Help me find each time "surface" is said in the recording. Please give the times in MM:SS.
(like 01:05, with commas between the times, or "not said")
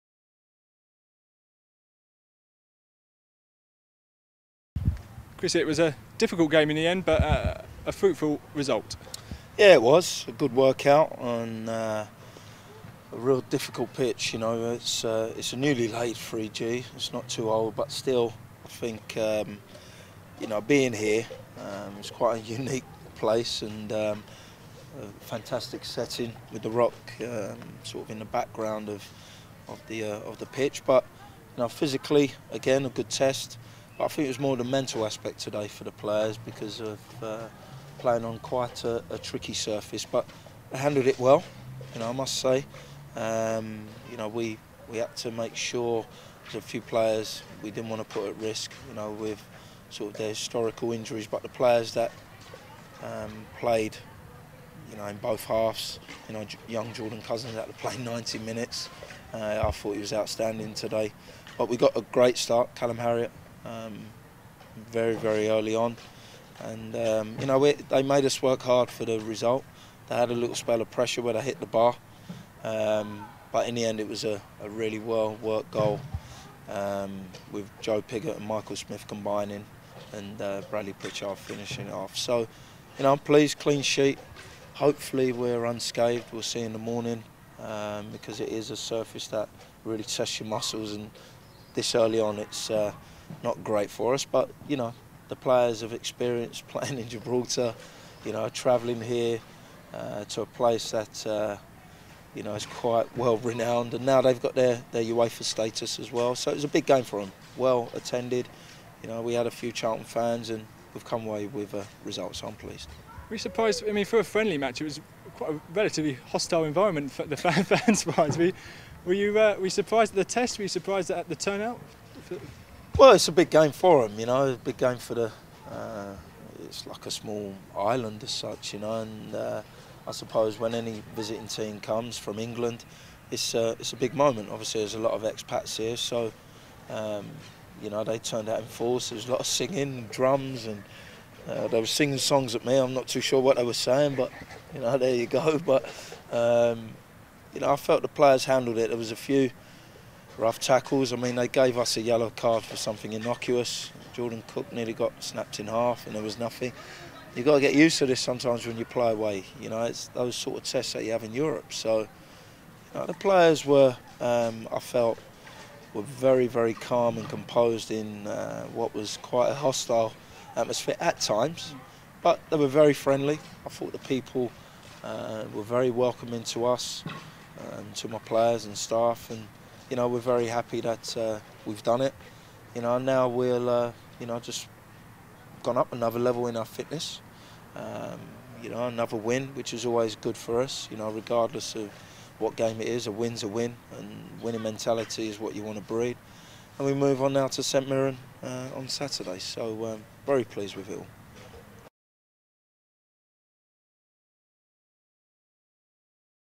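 00:39, 01:28.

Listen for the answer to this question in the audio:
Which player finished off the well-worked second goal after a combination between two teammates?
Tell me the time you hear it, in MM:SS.
01:20.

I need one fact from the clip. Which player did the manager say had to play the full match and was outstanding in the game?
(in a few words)
Jordan Cousins.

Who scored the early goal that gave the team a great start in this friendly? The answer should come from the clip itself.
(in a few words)
Callum Harriott.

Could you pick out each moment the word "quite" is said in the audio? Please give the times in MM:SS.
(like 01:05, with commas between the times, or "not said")
00:22, 00:38, 01:42, 01:55, 02:49.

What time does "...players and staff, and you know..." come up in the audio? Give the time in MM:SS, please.
02:58.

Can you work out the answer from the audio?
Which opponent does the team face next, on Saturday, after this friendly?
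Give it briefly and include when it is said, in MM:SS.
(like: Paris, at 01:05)
St Mirren, at 03:17.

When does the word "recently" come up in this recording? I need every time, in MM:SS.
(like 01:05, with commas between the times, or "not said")
not said.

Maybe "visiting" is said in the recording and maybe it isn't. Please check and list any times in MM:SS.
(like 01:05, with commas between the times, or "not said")
02:11.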